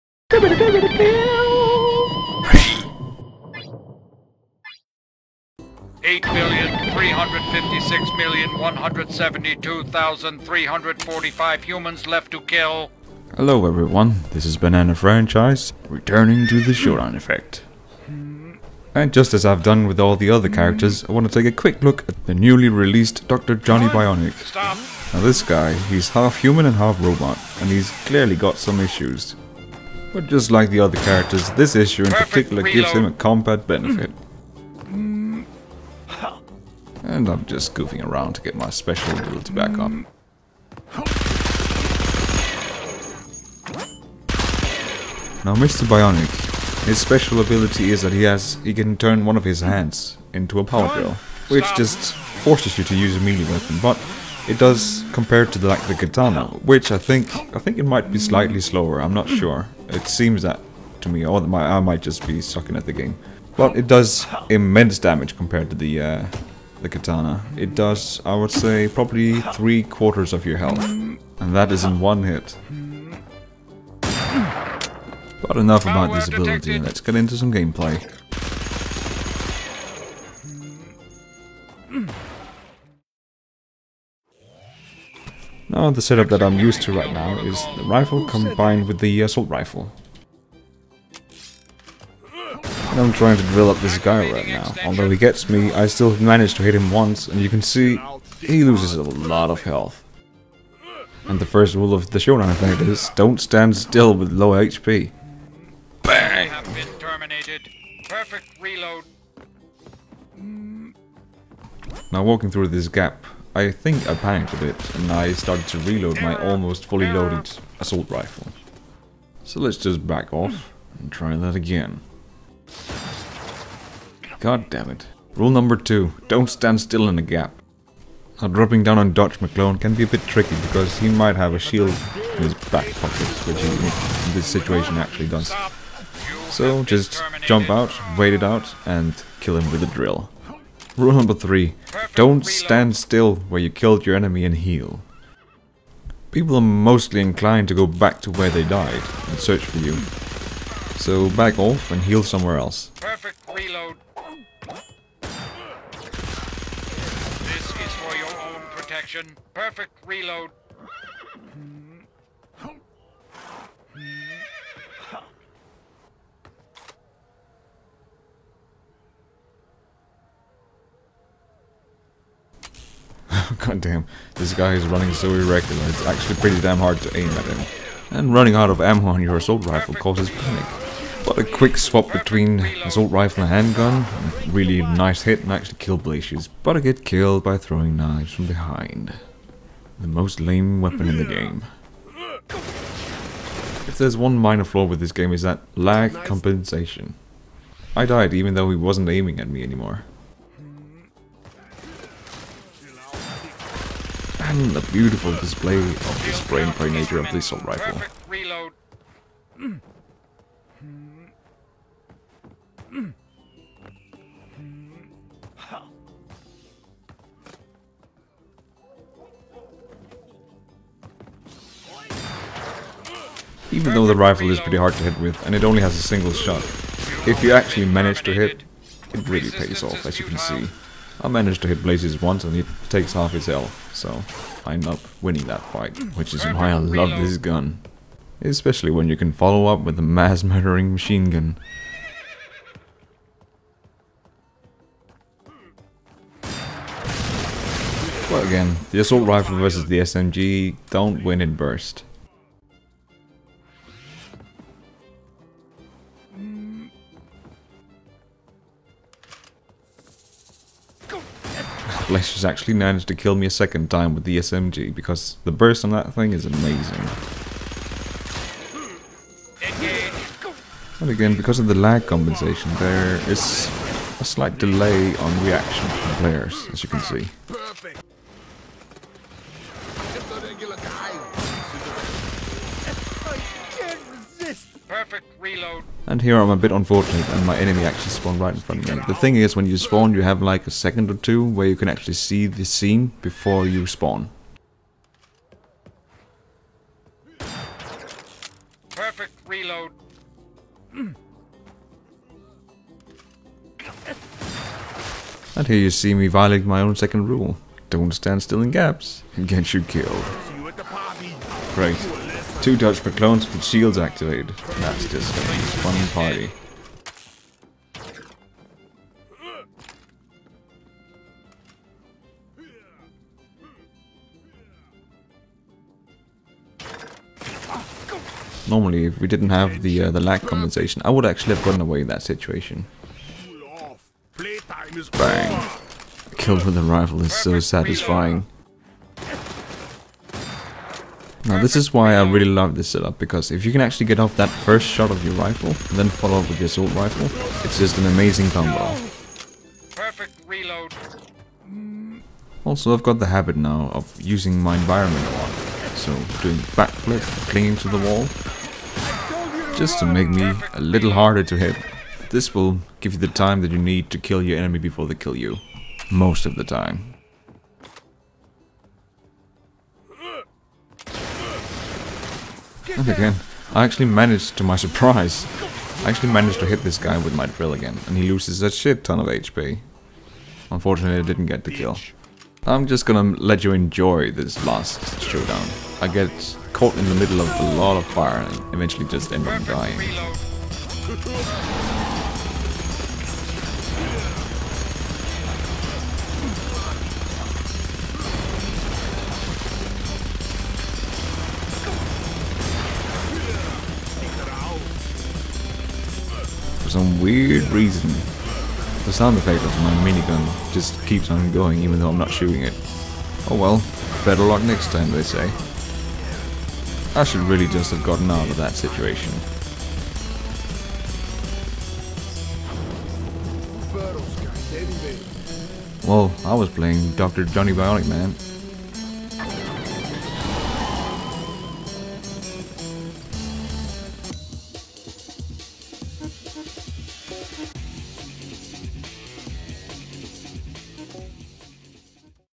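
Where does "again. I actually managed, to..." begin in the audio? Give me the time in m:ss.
6:13.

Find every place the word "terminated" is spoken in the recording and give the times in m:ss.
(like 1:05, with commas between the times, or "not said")
1:46.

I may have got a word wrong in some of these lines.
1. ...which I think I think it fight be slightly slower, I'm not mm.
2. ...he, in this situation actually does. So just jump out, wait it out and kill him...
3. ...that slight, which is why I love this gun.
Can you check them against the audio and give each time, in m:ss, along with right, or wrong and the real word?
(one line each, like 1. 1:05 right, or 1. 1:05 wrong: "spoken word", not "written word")
1. 0:56 wrong: "might", not "fight"
2. 2:13 right
3. 3:55 wrong: "fight", not "slight".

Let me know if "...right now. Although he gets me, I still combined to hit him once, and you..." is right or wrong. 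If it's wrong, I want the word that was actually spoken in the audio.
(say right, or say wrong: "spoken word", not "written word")
wrong: "managed", not "combined".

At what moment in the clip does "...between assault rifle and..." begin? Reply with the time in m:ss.
3:02.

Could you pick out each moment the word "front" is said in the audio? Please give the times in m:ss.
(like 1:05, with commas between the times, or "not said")
4:48.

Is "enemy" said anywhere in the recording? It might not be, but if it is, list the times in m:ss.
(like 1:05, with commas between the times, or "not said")
2:24, 4:47, 6:04.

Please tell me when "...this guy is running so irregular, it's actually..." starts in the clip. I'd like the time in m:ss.
2:54.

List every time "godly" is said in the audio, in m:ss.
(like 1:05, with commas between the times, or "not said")
not said.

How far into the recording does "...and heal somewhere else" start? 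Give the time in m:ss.
2:31.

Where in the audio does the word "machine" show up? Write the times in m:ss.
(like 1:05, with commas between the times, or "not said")
4:00.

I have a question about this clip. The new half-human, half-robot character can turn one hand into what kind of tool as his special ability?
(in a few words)
Power drill.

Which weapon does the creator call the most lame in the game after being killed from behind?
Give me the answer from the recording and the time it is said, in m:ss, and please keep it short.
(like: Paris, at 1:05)
Throwing knives, at 3:07.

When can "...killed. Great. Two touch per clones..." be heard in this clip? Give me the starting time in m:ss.
5:09.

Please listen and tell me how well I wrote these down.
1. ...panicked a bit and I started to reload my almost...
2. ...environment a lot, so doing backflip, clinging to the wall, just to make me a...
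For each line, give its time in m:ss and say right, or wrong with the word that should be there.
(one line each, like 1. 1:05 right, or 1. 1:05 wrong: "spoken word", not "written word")
1. 1:54 right
2. 5:54 right.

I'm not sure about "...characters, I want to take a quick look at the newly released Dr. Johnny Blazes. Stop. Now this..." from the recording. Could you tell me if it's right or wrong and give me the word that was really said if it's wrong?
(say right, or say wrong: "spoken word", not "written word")
wrong: "Bionic", not "Blazes".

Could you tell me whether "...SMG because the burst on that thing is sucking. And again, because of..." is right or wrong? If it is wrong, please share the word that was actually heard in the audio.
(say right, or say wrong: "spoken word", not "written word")
wrong: "amazing", not "sucking".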